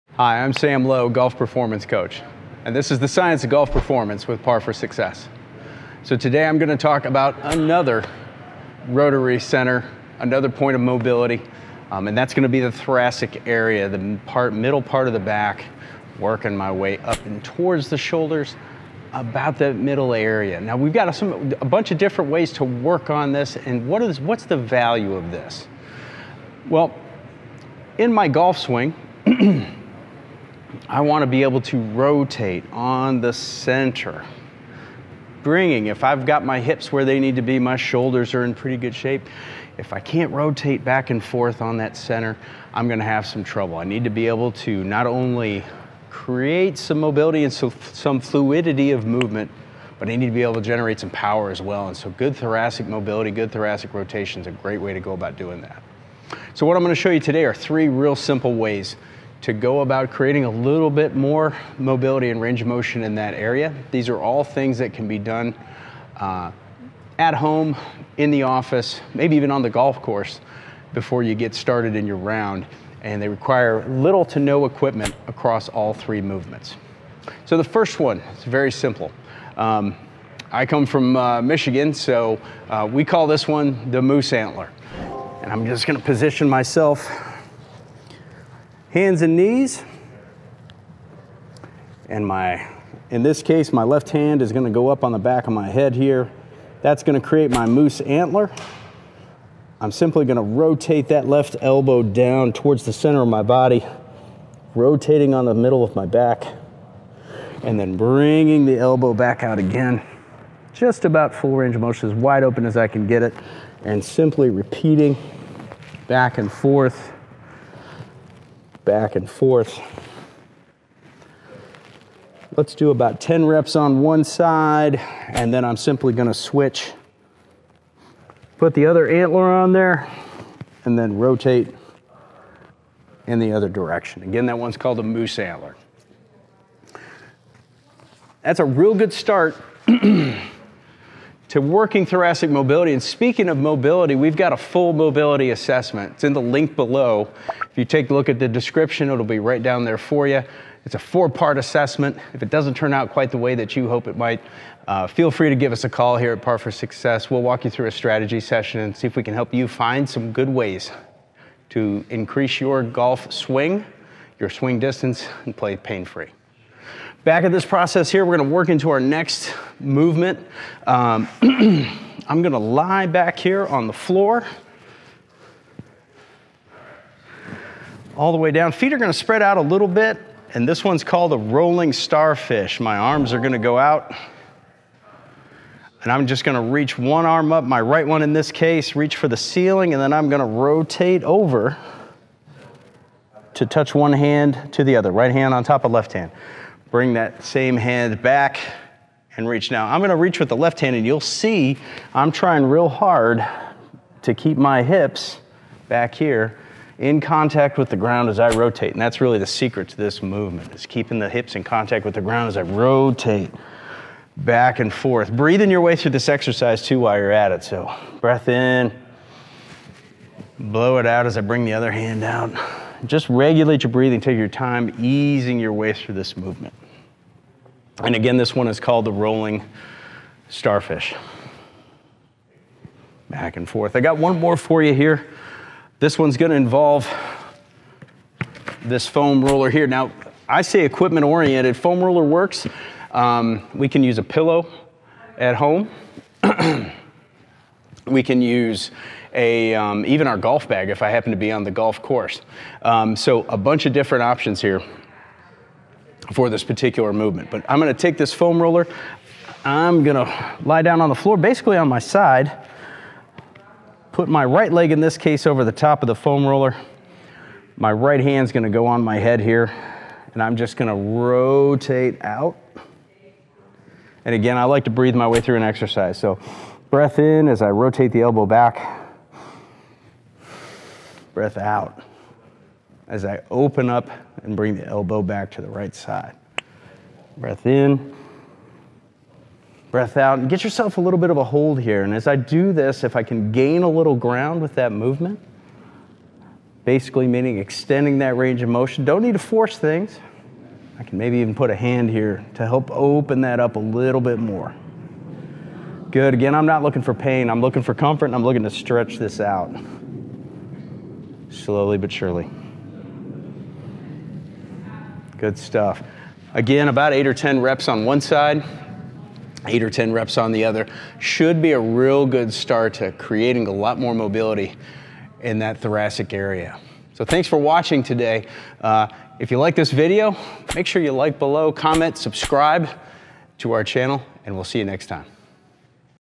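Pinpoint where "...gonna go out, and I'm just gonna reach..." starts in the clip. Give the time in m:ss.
3:03.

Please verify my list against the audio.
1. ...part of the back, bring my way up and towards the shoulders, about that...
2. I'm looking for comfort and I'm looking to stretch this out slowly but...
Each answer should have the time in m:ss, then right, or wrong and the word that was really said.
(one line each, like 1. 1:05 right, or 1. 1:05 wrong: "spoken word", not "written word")
1. 0:14 wrong: "working", not "bring"
2. 5:07 right.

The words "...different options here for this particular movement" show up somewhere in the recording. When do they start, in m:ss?
4:13.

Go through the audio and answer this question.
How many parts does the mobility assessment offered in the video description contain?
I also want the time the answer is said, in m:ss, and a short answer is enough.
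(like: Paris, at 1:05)
4, at 2:30.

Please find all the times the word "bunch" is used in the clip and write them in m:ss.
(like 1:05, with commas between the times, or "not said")
0:21, 4:13.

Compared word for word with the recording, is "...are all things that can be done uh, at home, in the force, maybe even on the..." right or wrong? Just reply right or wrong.
wrong.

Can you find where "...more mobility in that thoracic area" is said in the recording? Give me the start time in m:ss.
5:23.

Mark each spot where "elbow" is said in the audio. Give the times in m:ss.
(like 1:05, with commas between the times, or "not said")
1:41, 1:48, 4:38, 4:44.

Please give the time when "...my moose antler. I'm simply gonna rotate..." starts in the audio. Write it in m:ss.
1:37.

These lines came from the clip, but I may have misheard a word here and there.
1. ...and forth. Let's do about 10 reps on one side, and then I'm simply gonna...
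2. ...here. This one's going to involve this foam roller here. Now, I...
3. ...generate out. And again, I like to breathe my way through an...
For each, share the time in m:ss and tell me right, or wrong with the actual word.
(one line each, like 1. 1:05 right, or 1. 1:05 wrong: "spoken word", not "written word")
1. 1:59 right
2. 3:54 right
3. 4:30 wrong: "rotate", not "generate".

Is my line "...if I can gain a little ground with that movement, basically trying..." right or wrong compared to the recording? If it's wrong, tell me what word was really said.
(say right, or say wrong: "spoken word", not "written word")
wrong: "meaning", not "trying".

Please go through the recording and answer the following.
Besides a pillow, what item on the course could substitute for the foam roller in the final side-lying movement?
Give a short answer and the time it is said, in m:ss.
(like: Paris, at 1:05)
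golf bag, at 4:10.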